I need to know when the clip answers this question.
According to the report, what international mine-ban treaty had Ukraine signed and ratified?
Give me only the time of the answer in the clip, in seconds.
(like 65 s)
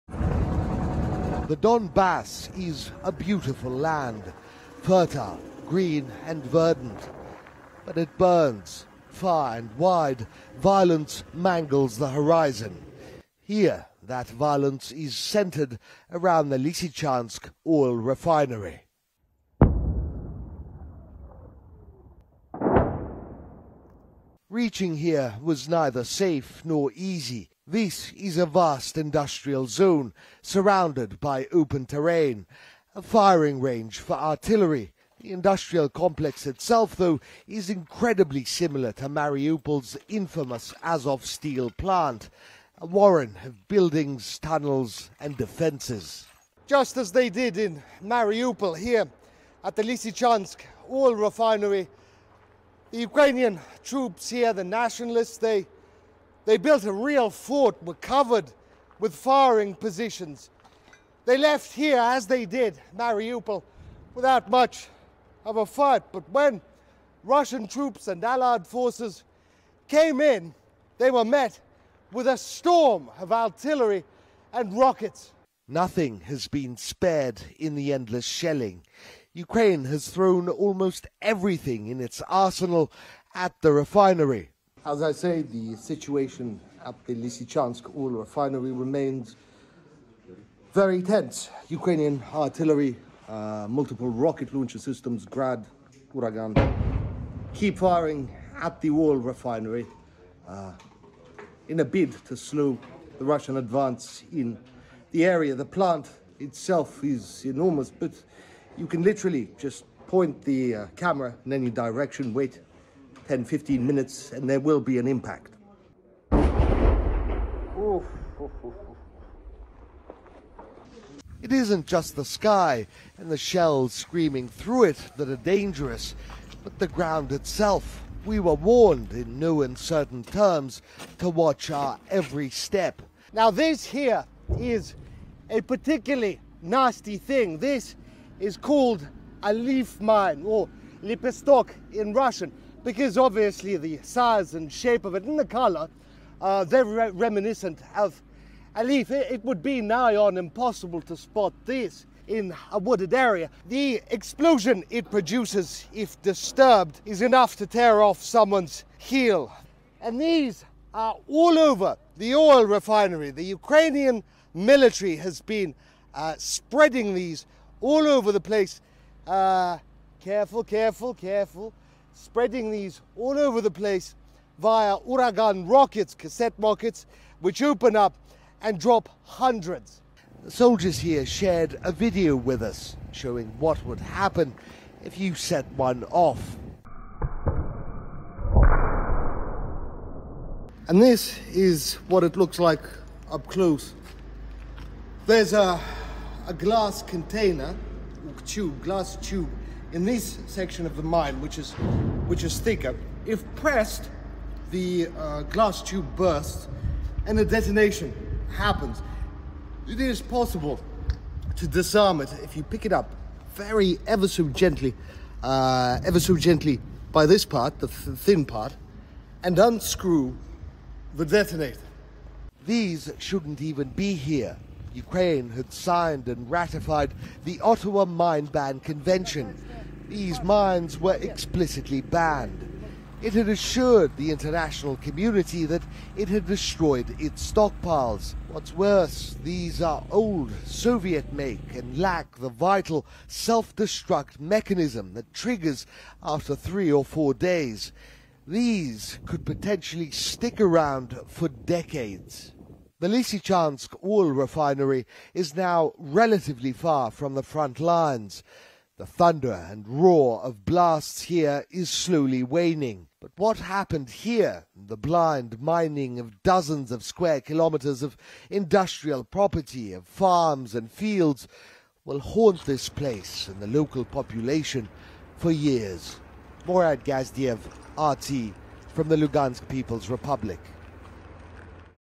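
227 s.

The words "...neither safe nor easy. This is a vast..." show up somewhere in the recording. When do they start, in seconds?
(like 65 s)
25 s.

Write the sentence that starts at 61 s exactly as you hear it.
They left here, as they did, Mariupol, without much of a fight.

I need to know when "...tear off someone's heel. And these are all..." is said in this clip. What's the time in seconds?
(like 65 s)
157 s.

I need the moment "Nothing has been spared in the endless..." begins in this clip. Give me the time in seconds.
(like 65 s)
75 s.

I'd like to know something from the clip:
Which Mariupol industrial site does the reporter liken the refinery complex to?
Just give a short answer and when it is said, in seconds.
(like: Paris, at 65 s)
Azov steel plant, at 40 s.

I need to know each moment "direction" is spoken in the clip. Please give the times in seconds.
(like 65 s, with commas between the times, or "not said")
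111 s.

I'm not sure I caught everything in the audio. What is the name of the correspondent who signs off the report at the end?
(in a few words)
Murad Gazdiev.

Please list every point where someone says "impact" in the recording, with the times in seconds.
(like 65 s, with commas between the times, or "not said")
115 s.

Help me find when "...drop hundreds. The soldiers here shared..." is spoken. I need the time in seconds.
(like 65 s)
178 s.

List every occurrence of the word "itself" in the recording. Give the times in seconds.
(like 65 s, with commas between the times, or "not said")
36 s, 106 s, 127 s.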